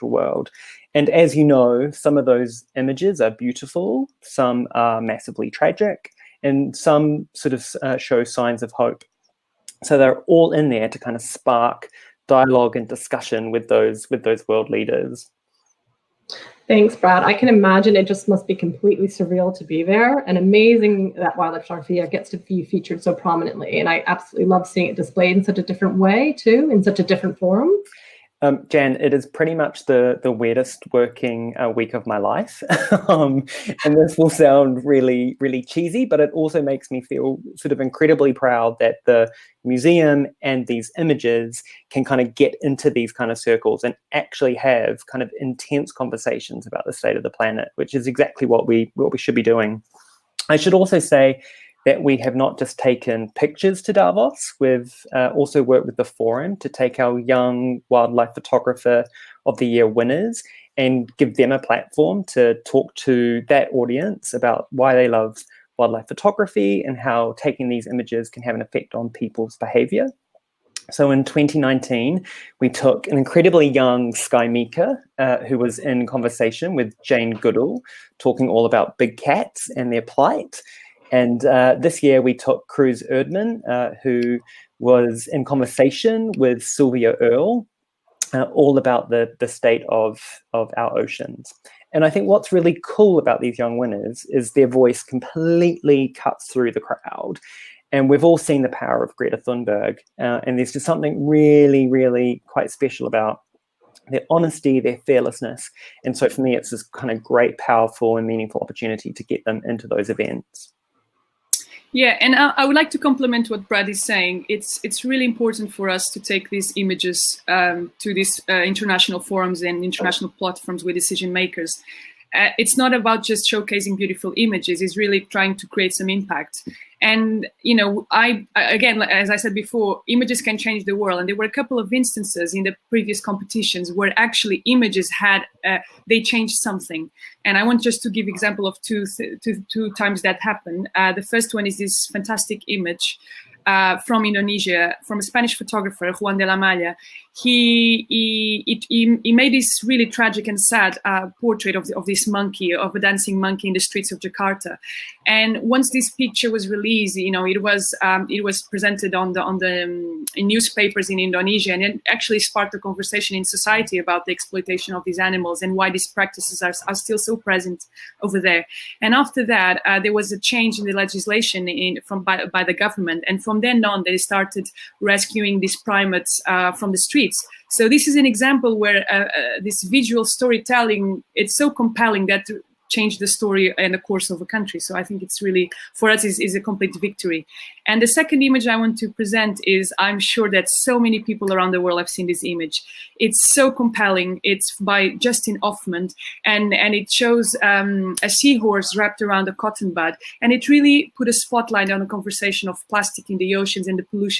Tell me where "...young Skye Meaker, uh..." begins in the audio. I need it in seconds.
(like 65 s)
73 s.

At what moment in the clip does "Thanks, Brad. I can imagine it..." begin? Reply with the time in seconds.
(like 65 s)
16 s.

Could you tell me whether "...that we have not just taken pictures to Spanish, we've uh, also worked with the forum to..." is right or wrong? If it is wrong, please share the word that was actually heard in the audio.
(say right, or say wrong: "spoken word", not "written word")
wrong: "Davos", not "Spanish".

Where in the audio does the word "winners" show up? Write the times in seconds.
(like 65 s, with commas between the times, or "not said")
59 s, 93 s.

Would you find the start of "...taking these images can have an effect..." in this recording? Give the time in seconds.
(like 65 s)
67 s.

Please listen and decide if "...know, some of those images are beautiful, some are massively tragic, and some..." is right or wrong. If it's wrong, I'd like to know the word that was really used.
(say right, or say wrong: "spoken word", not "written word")
right.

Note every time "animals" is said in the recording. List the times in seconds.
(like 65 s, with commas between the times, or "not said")
165 s.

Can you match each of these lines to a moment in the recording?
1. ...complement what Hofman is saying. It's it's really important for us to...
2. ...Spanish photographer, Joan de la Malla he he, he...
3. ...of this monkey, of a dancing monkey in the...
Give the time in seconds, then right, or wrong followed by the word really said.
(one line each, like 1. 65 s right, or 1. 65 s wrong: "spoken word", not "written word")
1. 112 s wrong: "Brad", not "Hofman"
2. 145 s right
3. 151 s right.